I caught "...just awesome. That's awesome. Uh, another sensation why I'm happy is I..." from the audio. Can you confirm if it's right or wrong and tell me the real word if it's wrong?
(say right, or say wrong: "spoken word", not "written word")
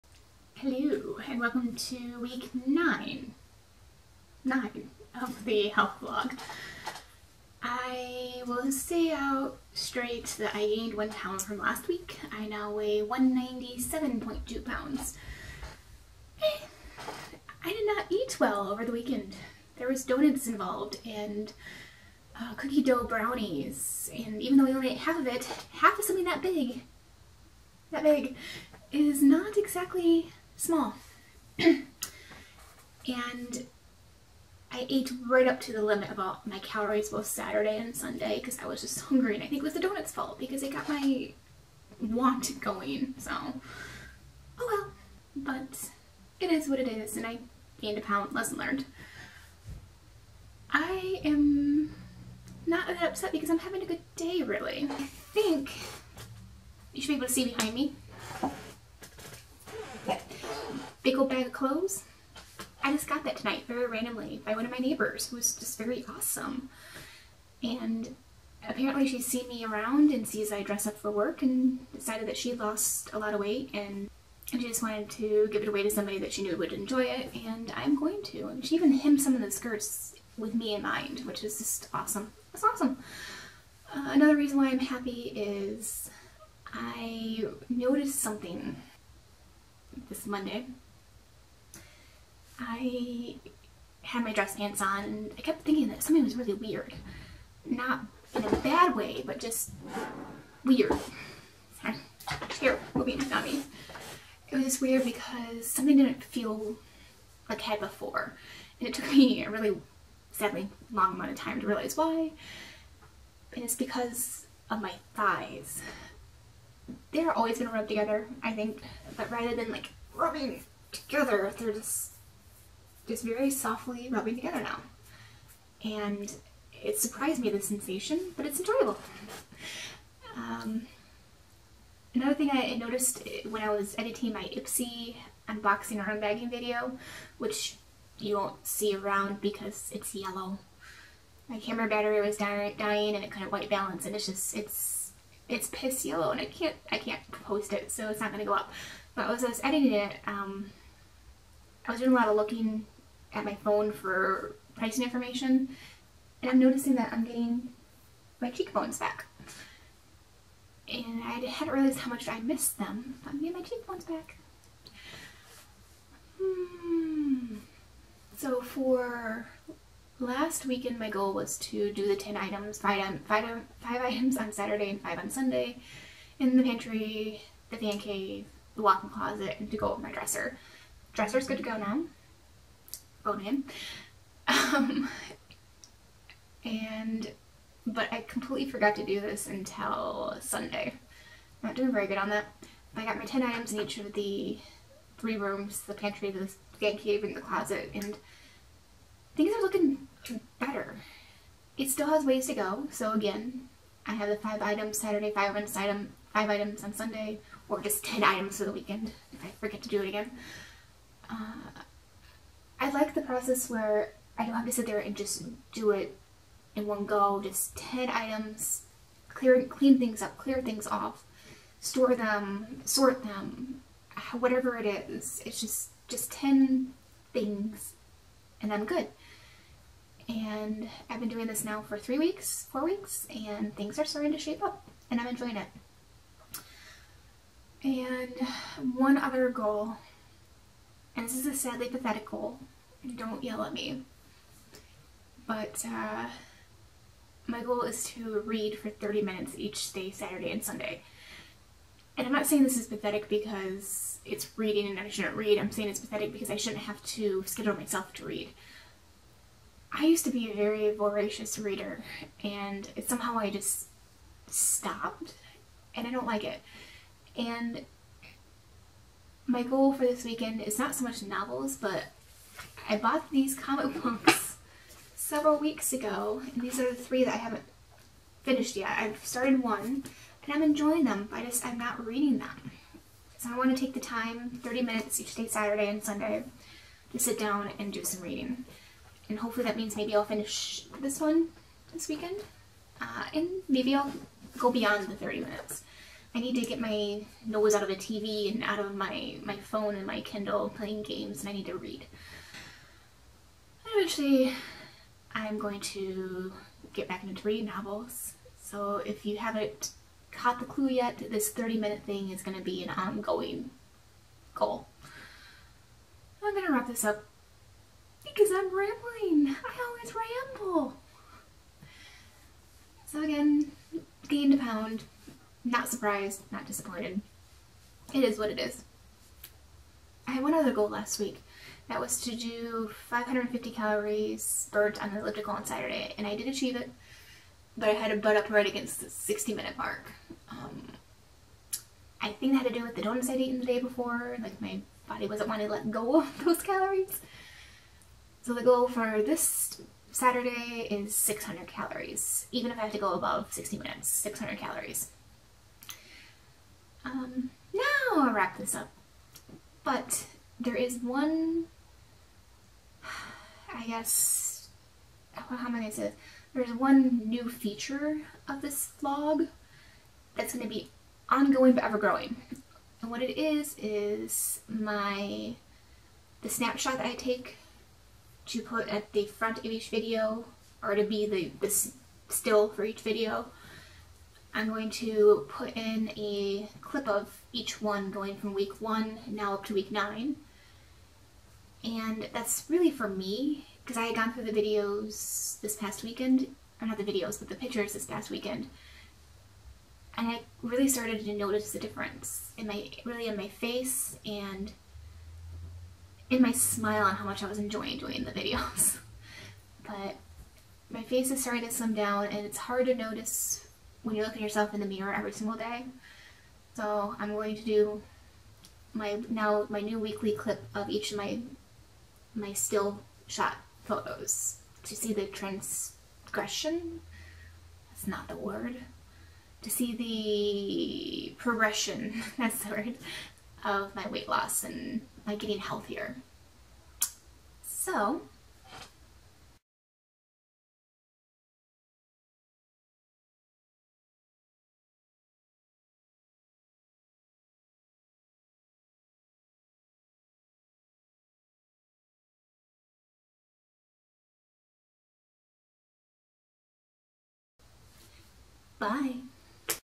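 wrong: "reason", not "sensation".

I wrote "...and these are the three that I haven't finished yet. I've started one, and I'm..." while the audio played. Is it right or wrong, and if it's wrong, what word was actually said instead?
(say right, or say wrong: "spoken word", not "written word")
right.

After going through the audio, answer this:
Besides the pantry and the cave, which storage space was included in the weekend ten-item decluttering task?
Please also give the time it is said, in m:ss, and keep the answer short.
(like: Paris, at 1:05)
Walk-in closet, at 2:58.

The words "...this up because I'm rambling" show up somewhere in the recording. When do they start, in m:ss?
5:16.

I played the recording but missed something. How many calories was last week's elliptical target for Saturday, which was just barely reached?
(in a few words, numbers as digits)
550.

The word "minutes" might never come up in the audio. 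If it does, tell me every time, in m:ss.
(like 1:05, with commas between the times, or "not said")
4:09, 4:44, 4:55, 5:11, 5:39, 5:53.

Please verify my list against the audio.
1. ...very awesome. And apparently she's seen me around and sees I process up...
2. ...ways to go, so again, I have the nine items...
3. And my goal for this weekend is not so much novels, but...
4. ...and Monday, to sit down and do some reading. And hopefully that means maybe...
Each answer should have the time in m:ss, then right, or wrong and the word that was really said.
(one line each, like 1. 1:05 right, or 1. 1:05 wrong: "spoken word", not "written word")
1. 1:05 wrong: "dress", not "process"
2. 3:22 wrong: "five", not "nine"
3. 4:27 right
4. 4:45 wrong: "Sunday", not "Monday".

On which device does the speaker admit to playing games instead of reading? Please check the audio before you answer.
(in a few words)
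Kindle.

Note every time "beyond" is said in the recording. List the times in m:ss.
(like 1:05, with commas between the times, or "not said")
4:54.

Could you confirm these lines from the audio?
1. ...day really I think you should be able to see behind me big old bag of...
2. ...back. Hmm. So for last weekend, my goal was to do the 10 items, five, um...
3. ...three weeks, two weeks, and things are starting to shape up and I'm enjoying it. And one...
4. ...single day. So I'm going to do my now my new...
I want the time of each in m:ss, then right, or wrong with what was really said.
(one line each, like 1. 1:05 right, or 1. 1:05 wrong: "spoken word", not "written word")
1. 0:54 right
2. 2:44 right
3. 3:51 wrong: "four", not "two"
4. 6:55 right.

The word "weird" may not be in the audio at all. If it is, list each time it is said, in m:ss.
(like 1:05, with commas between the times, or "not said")
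1:36, 1:40, 1:44.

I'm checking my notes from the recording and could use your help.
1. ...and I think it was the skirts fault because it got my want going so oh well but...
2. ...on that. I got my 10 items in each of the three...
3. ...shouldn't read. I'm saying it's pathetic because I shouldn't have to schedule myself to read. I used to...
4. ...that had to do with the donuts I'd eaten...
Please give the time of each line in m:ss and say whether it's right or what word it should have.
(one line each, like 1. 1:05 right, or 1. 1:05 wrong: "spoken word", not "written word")
1. 0:39 wrong: "donuts", not "skirts"
2. 3:12 right
3. 4:15 right
4. 5:42 right.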